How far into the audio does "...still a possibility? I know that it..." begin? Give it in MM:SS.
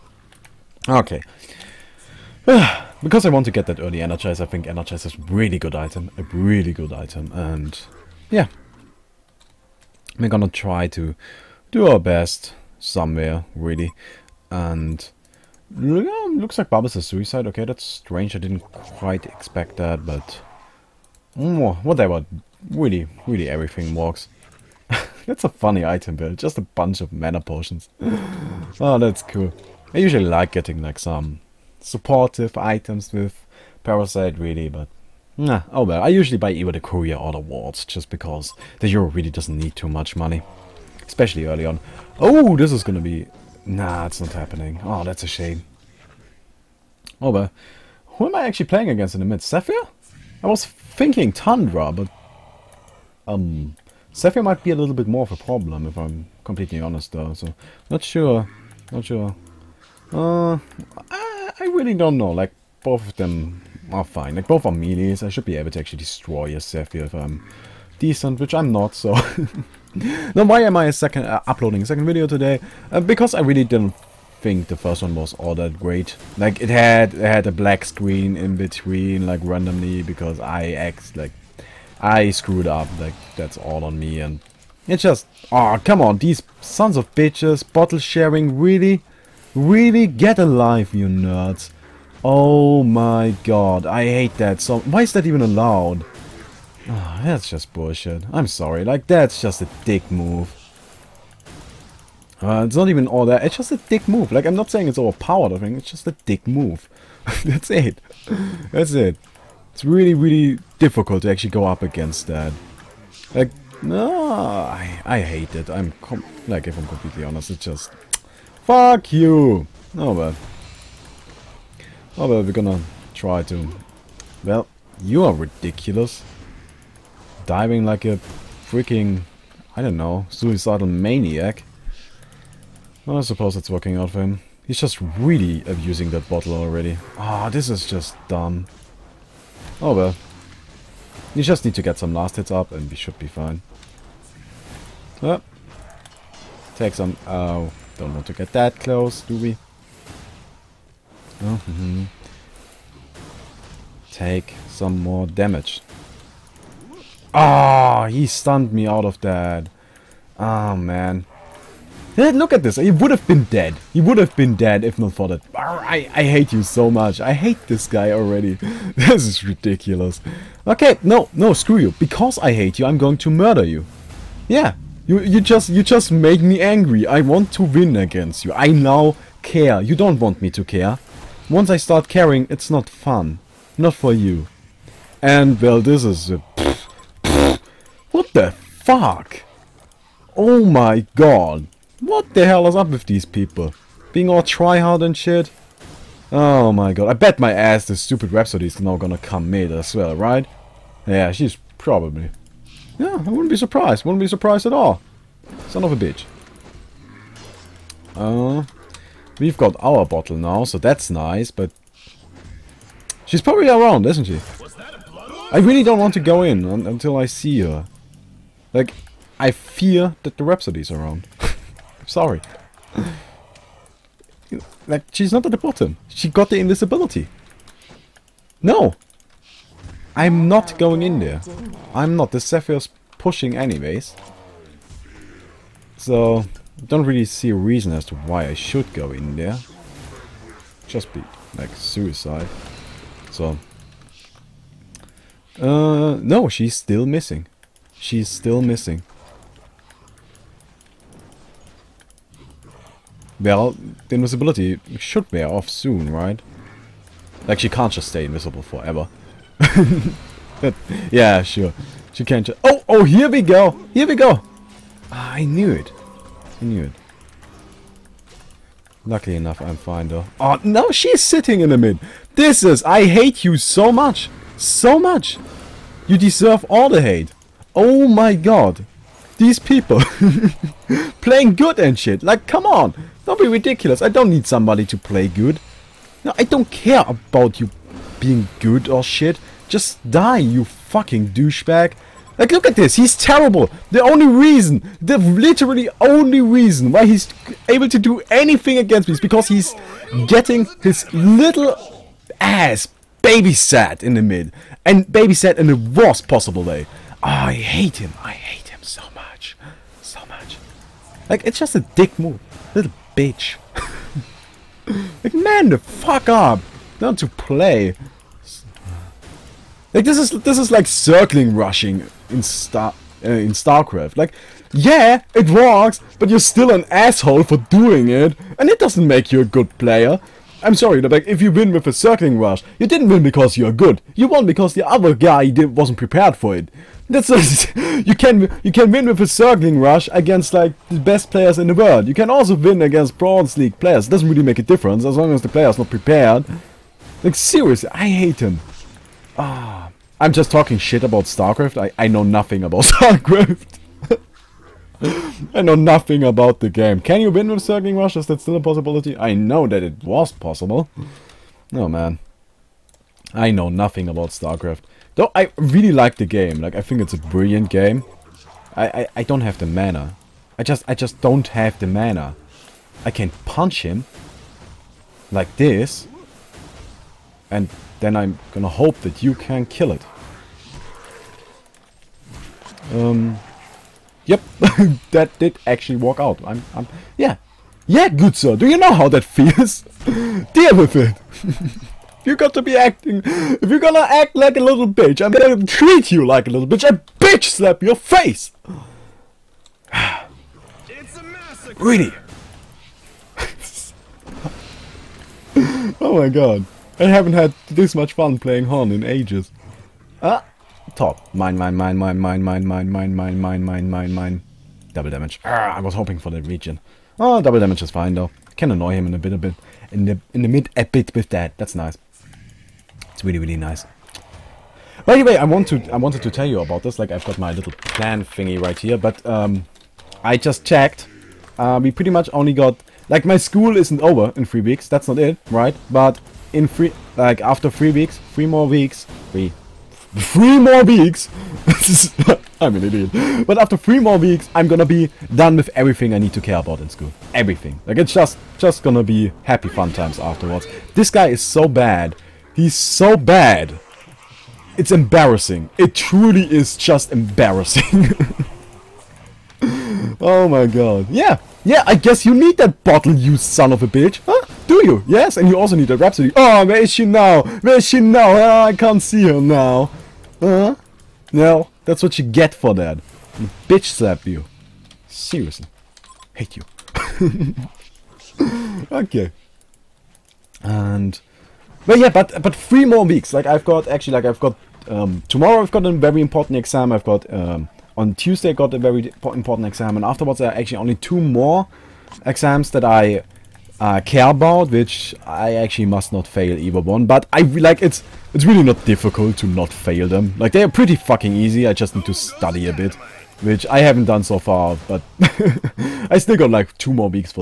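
05:58.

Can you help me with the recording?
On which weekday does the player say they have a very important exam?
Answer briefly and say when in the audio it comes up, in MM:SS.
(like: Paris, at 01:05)
Tuesday, at 08:07.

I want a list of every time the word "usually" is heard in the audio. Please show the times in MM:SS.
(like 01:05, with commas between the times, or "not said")
00:29, 00:36.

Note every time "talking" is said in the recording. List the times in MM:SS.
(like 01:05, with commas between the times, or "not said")
05:50.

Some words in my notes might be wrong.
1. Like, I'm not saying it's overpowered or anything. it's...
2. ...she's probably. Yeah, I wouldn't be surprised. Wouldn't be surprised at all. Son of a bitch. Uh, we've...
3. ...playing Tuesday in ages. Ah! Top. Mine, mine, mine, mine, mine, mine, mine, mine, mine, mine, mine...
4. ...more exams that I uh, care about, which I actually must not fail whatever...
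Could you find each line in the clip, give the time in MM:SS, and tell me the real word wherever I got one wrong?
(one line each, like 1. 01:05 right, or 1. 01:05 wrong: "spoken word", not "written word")
1. 01:44 right
2. 03:21 right
3. 06:48 wrong: "Hon", not "Tuesday"
4. 08:11 wrong: "either", not "whatever".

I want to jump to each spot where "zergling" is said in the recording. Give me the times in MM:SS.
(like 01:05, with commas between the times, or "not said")
05:20, 05:31, 05:39, 05:57.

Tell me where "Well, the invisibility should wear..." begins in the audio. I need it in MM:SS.
04:13.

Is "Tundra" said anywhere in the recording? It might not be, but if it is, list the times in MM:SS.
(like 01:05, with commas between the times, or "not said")
00:51.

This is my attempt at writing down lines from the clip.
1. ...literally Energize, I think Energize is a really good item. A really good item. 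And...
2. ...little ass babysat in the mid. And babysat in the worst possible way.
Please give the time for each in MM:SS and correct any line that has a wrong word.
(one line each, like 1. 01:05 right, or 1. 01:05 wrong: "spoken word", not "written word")
1. 00:03 wrong: "early", not "literally"
2. 05:01 right.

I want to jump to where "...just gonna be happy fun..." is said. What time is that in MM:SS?
07:28.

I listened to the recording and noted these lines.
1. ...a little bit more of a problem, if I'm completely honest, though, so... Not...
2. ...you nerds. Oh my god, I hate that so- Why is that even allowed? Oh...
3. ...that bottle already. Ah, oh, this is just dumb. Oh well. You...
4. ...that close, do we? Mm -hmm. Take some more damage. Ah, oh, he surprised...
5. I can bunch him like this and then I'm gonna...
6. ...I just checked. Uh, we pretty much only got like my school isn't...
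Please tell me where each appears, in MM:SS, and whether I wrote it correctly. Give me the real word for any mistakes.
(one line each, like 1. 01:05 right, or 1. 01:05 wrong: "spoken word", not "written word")
1. 00:54 right
2. 01:30 right
3. 02:16 right
4. 02:28 wrong: "stunned", not "surprised"
5. 06:13 wrong: "punch", not "bunch"
6. 07:10 right.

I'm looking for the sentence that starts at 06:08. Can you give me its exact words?
I, I, I don't have the mana.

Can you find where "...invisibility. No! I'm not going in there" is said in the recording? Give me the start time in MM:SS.
03:46.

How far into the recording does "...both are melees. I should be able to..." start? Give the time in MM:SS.
01:04.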